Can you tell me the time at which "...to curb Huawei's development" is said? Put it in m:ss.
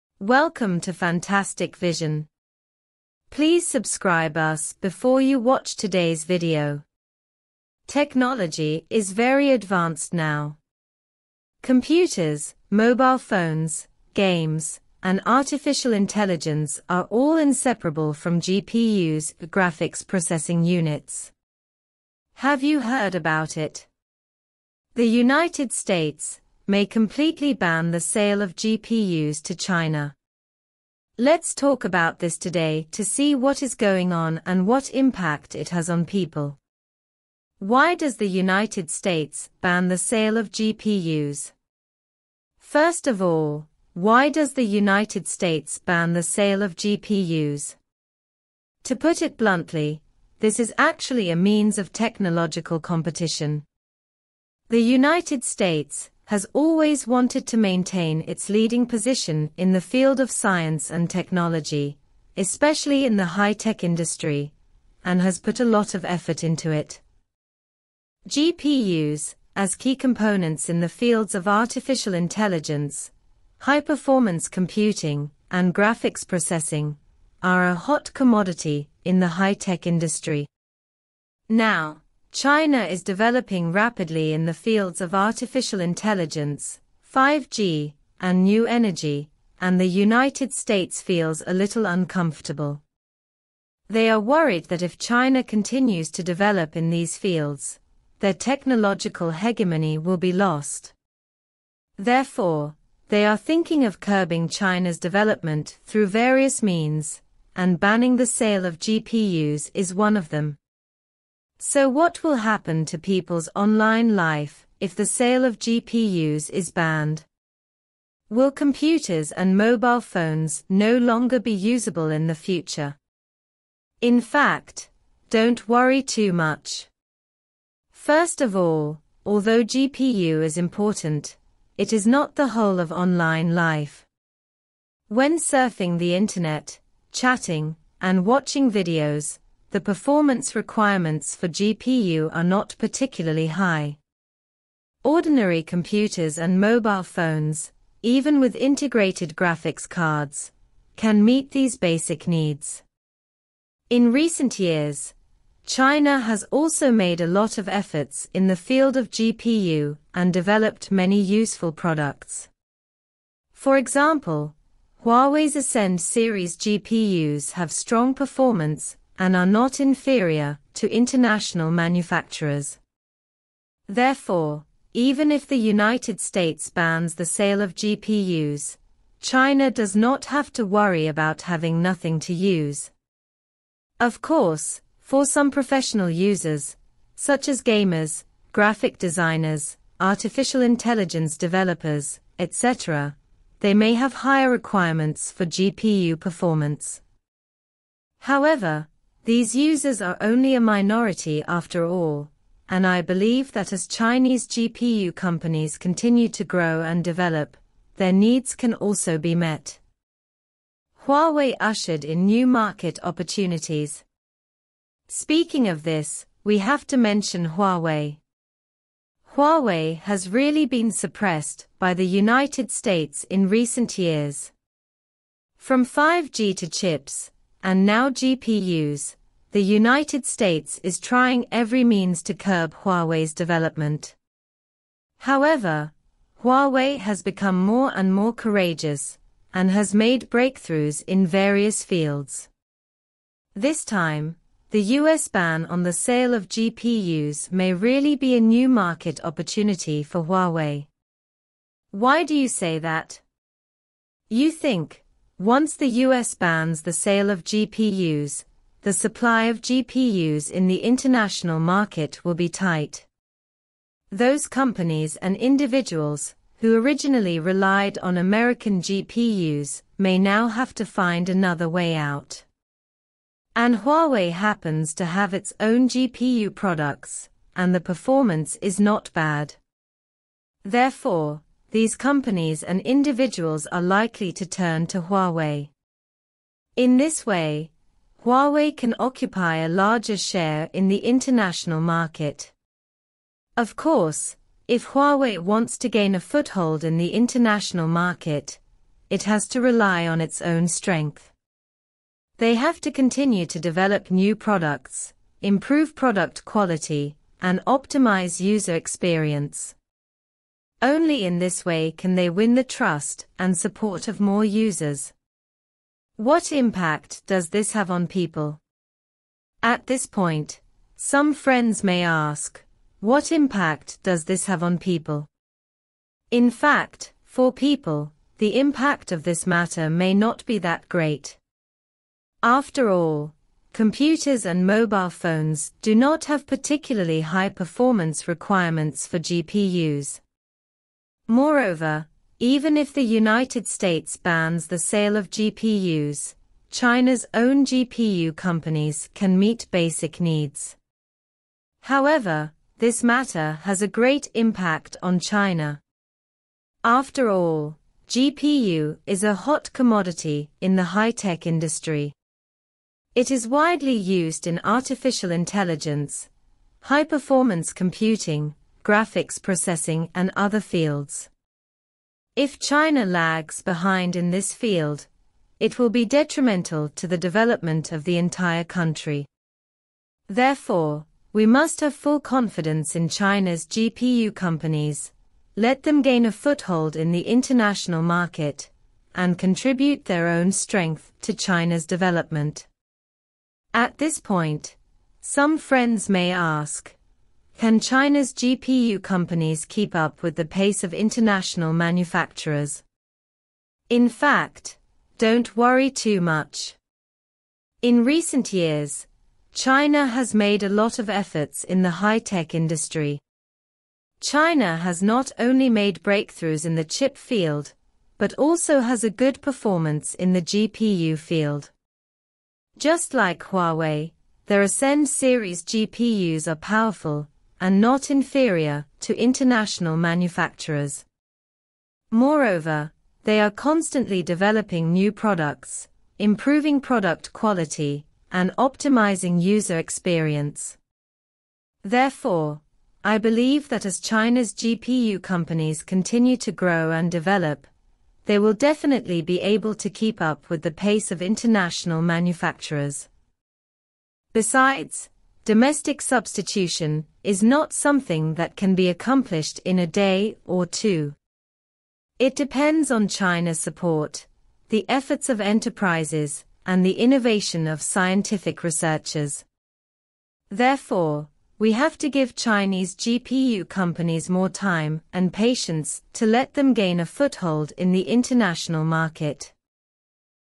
3:52.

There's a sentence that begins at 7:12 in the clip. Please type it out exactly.
Moreover, they are constantly developing new products, improving product quality, and optimizing user experience.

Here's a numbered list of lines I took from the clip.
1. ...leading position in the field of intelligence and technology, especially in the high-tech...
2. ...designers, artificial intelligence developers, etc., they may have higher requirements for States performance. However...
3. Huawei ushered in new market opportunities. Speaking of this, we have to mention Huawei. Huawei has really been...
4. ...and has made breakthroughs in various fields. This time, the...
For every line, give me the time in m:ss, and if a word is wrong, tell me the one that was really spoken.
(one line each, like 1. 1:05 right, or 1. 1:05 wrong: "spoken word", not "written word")
1. 0:58 wrong: "science", not "intelligence"
2. 3:08 wrong: "GPU", not "States"
3. 3:31 right
4. 3:59 right.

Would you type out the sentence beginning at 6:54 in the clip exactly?
China has not only made breakthroughs in the chip field, but also has a good performance in the GPU field.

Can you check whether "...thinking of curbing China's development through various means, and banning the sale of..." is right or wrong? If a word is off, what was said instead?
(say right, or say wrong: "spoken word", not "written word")
right.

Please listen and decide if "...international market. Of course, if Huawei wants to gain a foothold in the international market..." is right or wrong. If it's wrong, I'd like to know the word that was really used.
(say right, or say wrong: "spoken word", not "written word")
right.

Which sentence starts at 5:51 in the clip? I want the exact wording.
However, this matter has a great impact on China.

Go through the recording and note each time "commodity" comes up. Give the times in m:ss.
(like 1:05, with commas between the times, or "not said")
1:18, 5:59.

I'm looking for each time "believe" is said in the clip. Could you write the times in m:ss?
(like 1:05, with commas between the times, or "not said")
3:23, 7:23.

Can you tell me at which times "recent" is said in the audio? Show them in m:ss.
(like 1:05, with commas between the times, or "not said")
2:34, 3:43, 6:48.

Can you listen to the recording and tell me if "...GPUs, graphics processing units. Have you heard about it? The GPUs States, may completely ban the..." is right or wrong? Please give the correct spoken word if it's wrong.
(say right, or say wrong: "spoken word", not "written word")
wrong: "United", not "GPUs".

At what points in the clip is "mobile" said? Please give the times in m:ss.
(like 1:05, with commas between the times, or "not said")
0:12, 1:59, 2:26, 5:34.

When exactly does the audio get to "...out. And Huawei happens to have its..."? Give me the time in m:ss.
4:31.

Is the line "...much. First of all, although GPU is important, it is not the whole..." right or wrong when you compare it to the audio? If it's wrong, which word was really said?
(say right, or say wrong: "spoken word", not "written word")
right.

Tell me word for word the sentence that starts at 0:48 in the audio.
To put it bluntly, this is actually a means of technological competition.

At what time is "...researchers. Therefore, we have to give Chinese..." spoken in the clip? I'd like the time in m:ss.
7:48.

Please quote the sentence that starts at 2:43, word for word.
For example, Huawei's Ascend series GPUs have strong performance and are not inferior to international manufacturers.